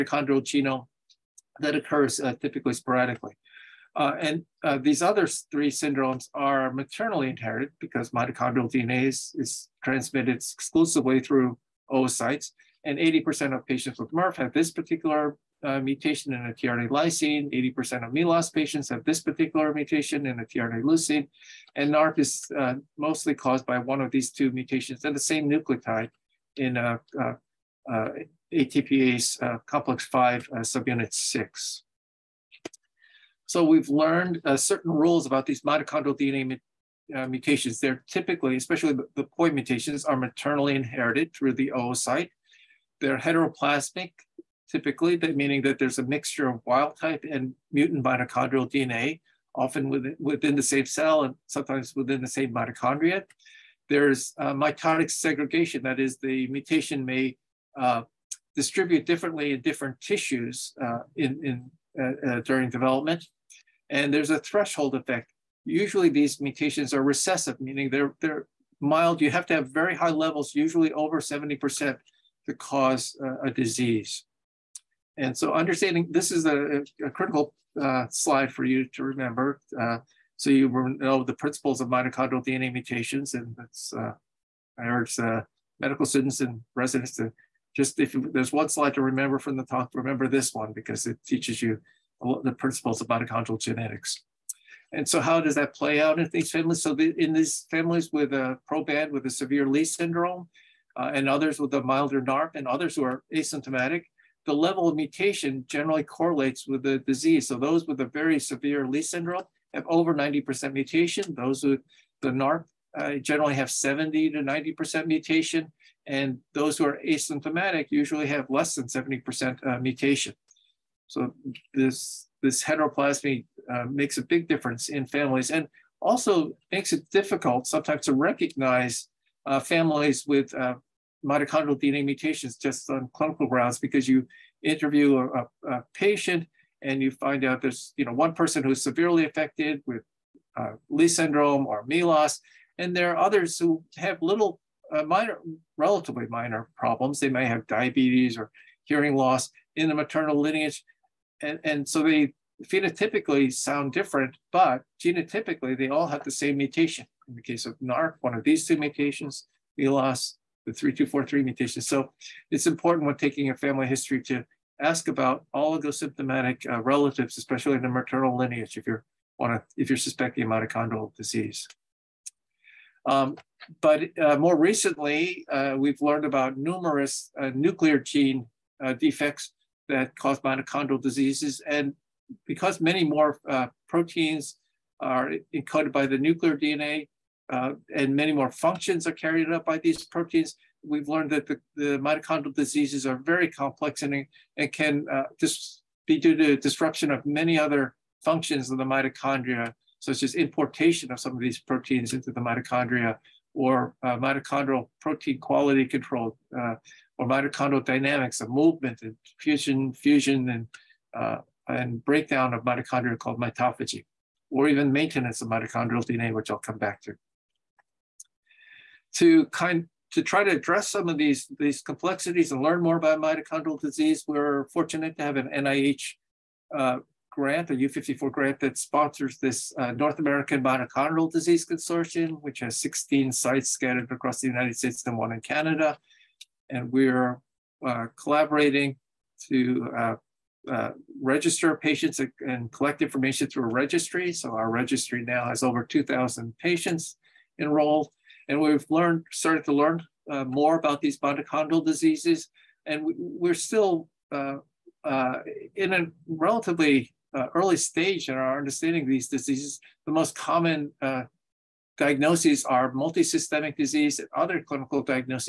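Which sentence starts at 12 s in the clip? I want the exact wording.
And 80% of patients with MERRF have this particular uh, mutation in a tRNA lysine.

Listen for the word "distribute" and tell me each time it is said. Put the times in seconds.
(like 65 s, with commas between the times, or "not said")
58 s.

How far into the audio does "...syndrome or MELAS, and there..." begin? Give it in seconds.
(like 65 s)
141 s.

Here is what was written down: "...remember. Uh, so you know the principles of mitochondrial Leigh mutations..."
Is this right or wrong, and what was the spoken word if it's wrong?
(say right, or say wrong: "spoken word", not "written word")
wrong: "DNA", not "Leigh".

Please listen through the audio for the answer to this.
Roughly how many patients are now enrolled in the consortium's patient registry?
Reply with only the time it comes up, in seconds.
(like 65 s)
245 s.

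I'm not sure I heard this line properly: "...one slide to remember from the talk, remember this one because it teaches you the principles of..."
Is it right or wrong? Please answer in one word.
right.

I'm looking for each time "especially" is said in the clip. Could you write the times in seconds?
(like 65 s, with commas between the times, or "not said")
38 s, 167 s.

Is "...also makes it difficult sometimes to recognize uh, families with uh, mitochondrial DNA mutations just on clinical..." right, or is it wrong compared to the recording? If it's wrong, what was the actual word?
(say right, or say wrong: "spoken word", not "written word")
right.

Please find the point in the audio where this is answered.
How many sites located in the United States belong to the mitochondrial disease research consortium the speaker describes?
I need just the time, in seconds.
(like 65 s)
232 s.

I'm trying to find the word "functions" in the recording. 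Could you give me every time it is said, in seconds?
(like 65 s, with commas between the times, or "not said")
188 s, 198 s.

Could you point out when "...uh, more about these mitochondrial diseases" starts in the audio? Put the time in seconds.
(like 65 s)
250 s.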